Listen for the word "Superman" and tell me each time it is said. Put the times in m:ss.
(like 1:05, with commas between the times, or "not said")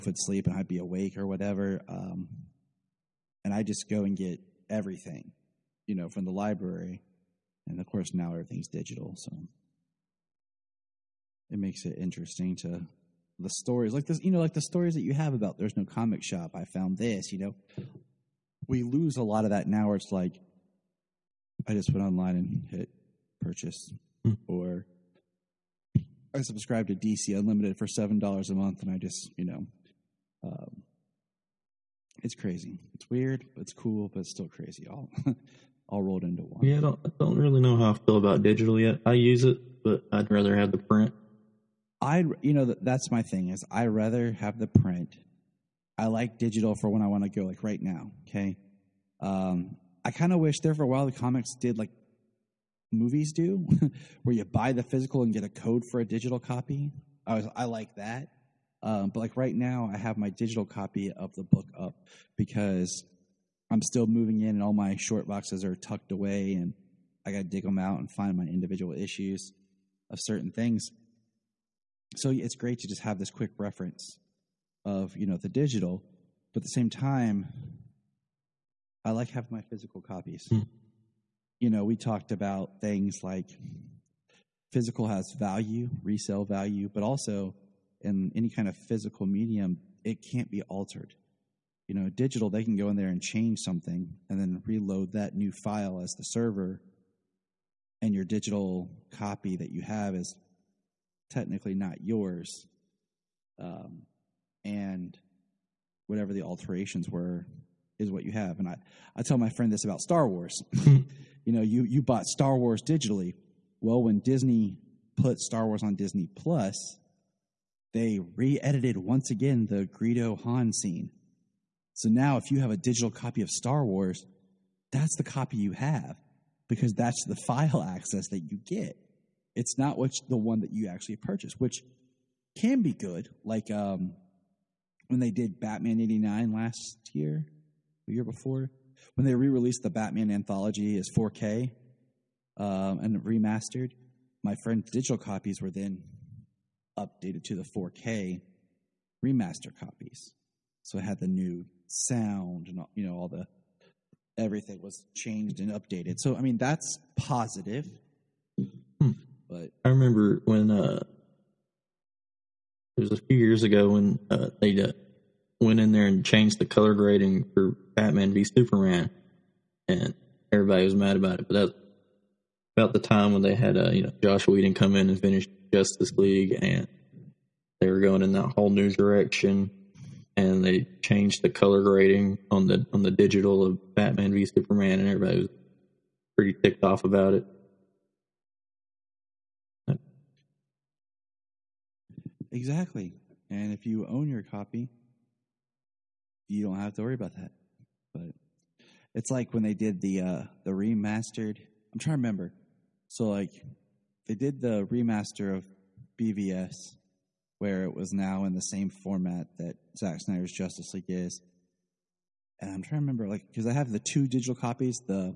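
2:48, 3:04.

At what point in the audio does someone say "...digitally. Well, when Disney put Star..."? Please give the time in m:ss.
1:52.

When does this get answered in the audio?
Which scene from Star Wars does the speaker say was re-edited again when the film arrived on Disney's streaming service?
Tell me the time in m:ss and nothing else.
1:59.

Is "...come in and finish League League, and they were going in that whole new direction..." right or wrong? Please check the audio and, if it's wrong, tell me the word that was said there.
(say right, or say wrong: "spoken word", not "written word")
wrong: "Justice", not "League".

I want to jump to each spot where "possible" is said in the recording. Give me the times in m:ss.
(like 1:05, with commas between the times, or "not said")
not said.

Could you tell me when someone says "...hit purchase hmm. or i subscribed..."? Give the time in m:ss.
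0:22.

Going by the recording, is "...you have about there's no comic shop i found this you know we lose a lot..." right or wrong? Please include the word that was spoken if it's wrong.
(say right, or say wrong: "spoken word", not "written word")
right.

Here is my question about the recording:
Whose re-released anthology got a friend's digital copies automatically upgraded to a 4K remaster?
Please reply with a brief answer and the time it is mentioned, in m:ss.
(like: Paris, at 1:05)
Batman '89, at 2:15.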